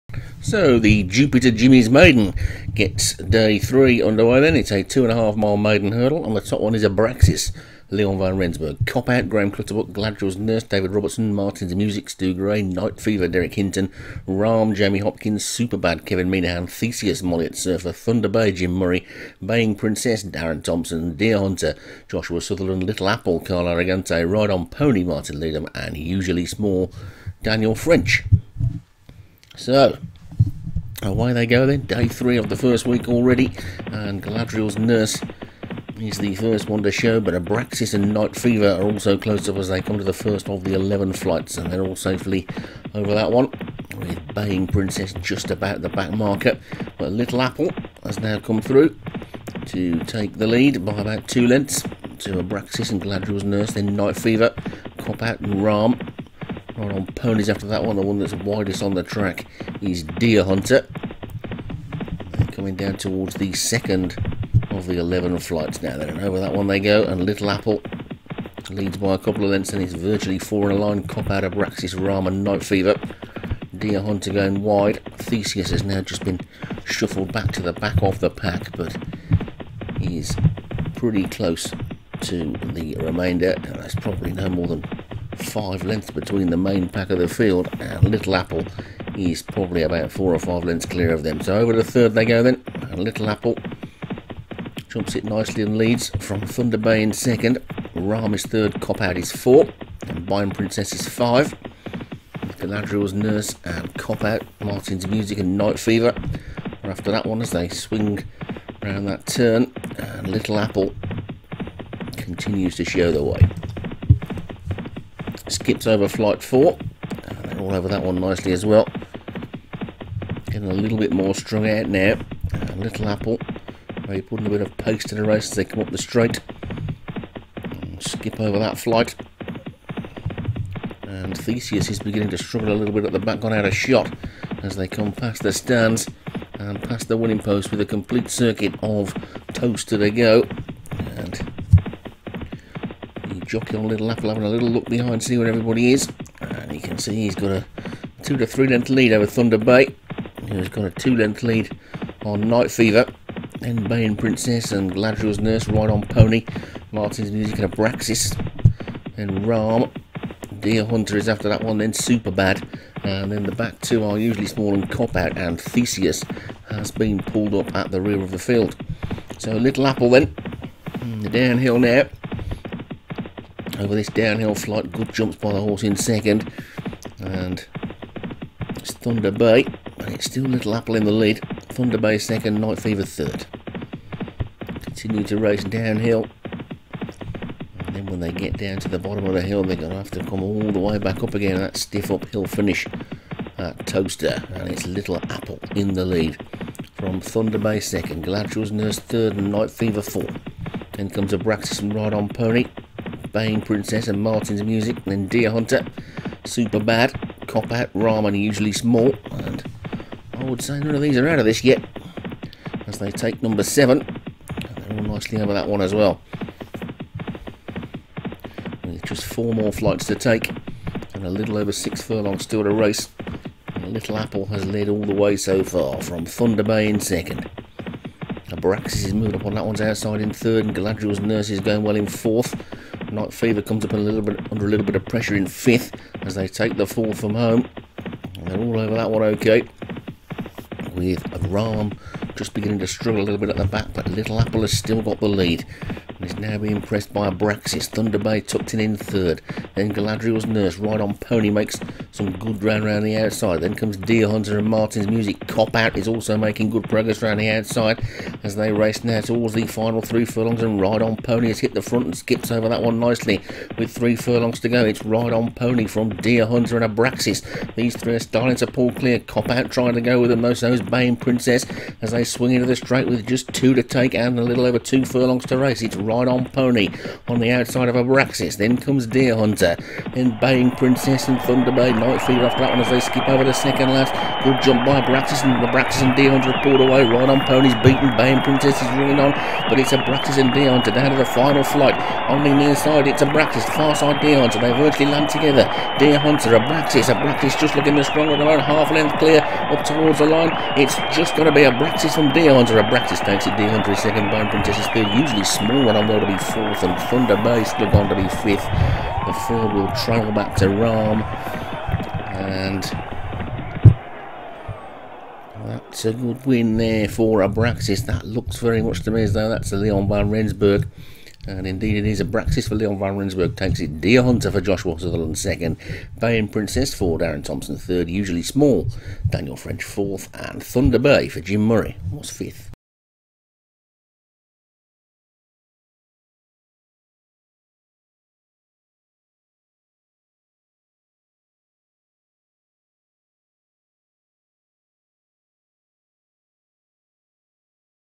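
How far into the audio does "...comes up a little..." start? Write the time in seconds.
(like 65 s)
233 s.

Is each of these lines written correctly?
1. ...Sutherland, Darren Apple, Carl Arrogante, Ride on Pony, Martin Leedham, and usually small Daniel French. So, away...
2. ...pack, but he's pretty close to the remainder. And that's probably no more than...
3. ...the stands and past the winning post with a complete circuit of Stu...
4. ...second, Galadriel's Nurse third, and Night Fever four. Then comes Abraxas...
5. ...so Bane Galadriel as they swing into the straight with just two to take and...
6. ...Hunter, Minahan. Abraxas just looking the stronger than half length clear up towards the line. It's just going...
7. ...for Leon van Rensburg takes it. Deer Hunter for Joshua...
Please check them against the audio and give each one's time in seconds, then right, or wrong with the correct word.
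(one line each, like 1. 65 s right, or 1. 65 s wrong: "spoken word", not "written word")
1. 22 s wrong: "Little", not "Darren"
2. 78 s right
3. 135 s wrong: "Towcester", not "Stu"
4. 197 s right
5. 270 s wrong: "Princess", not "Galadriel"
6. 296 s wrong: "Abraxas", not "Minahan"
7. 322 s right.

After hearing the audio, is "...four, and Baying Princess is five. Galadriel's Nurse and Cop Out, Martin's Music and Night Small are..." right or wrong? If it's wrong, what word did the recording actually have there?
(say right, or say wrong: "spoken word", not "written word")
wrong: "Fever", not "Small".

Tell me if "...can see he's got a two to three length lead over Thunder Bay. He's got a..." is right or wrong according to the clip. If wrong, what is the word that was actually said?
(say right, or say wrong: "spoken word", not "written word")
right.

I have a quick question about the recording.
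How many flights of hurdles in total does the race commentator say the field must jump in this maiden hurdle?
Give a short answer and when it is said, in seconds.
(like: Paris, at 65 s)
11, at 40 s.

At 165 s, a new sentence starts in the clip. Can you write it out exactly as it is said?
And Theseus has been pulled up at the rear of the field.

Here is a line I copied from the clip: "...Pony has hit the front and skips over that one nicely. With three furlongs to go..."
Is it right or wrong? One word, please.
right.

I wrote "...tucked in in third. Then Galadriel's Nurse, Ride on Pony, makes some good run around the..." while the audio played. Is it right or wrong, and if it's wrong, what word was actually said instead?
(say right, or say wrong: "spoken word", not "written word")
right.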